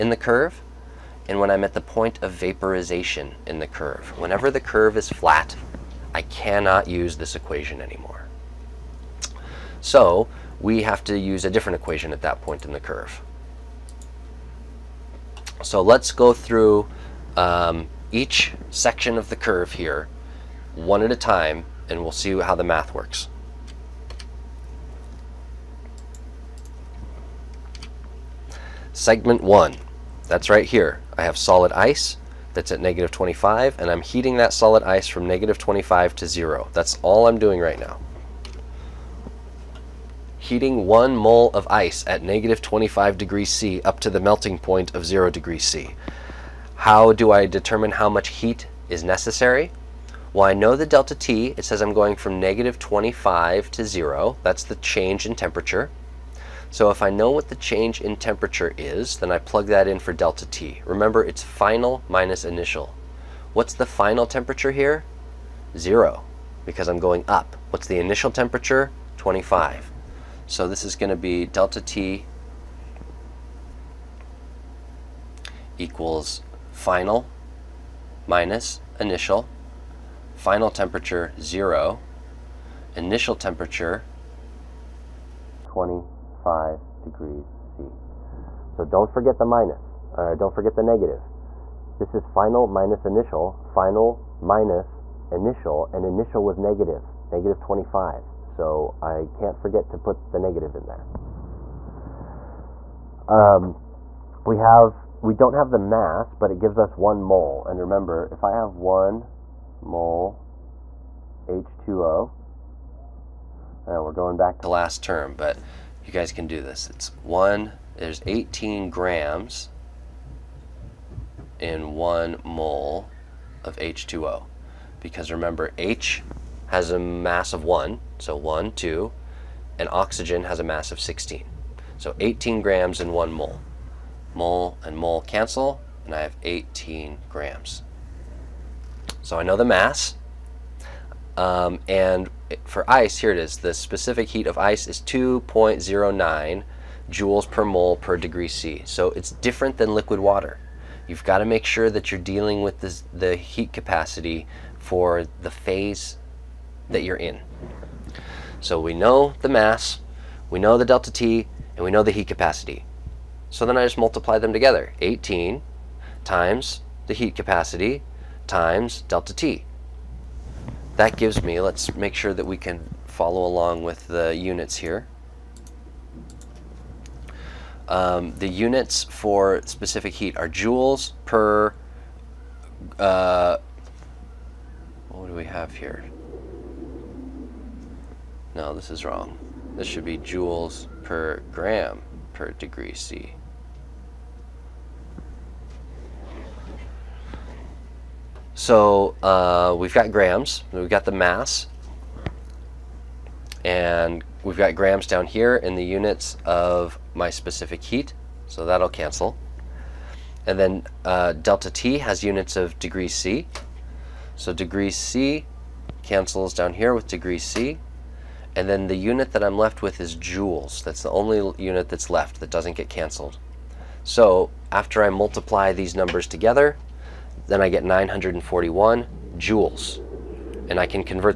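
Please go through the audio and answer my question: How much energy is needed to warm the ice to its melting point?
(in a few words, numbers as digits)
941 joules.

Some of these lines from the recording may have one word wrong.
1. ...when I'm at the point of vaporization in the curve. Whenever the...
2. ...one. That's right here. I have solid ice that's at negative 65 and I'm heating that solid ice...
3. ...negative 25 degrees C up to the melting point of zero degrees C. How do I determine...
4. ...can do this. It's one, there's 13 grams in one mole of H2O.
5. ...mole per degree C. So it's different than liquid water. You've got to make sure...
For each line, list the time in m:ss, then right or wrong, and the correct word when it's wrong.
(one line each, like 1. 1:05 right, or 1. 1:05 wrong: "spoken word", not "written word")
1. 0:01 right
2. 0:29 wrong: "25", not "65"
3. 0:42 right
4. 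1:56 wrong: "18", not "13"
5. 2:27 right.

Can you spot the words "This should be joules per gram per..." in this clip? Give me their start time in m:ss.
3:09.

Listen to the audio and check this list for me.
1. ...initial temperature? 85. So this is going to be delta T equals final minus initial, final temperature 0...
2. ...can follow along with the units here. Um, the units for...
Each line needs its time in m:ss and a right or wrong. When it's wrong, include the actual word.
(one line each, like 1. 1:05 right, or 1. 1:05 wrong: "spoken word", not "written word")
1. 1:07 wrong: "25", not "85"
2. 2:52 right.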